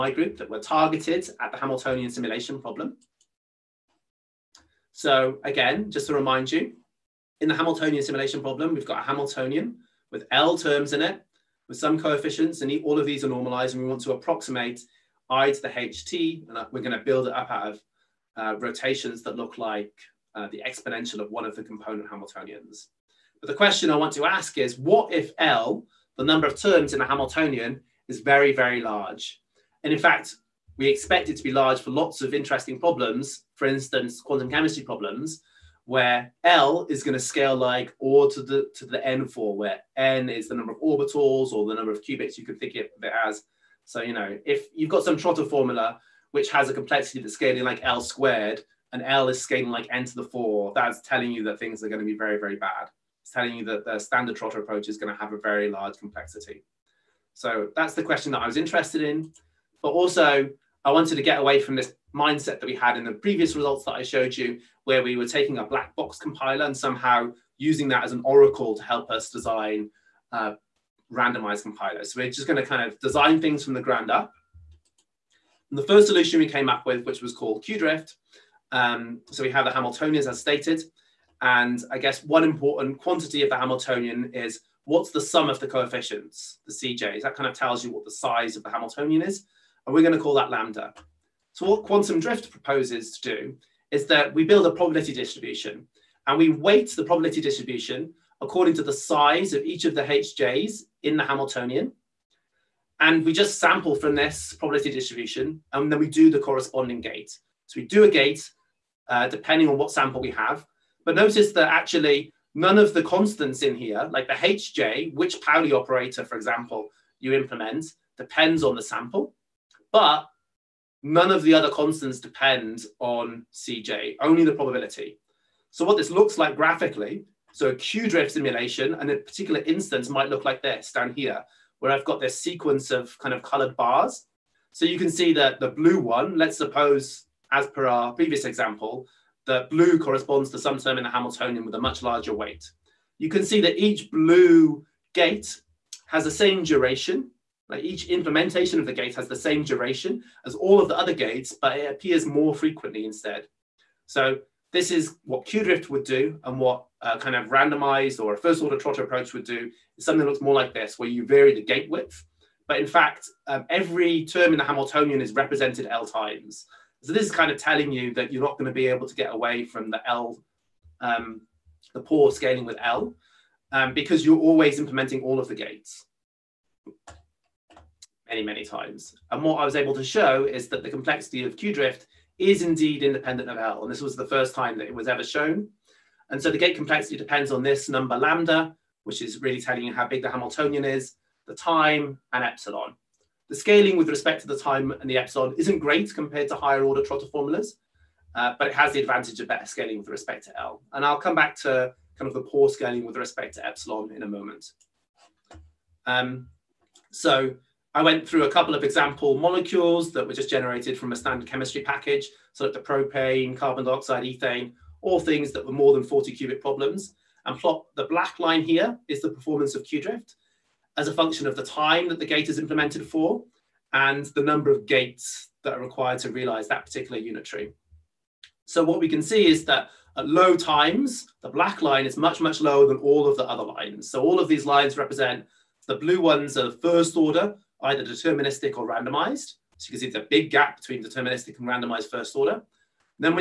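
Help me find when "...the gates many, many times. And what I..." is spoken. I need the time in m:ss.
2:55.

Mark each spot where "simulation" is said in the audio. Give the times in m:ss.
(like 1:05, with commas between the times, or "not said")
0:02, 0:08, 2:08.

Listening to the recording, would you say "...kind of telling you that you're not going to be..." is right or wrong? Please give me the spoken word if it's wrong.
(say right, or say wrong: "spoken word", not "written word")
right.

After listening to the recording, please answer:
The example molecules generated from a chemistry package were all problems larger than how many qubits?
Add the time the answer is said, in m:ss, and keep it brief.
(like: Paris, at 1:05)
40, at 3:36.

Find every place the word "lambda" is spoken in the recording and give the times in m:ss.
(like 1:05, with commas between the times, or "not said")
1:30, 3:08.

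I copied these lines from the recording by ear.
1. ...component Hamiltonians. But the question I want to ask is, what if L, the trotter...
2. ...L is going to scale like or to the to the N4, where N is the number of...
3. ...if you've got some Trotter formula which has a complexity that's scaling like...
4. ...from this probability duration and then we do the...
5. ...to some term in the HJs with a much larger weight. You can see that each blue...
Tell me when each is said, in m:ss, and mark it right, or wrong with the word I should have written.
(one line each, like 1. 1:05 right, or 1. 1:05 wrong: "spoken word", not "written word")
1. 0:21 wrong: "number", not "trotter"
2. 0:36 right
3. 0:44 right
4. 1:43 wrong: "distribution", not "duration"
5. 2:20 wrong: "Hamiltonian", not "HJs".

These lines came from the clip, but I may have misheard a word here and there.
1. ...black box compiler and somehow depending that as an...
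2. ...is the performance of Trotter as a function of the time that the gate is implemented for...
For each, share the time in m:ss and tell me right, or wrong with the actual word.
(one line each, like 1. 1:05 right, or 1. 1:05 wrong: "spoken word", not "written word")
1. 1:05 wrong: "using", not "depending"
2. 3:39 wrong: "Qdrift", not "Trotter".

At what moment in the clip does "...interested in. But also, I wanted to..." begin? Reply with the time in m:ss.
0:58.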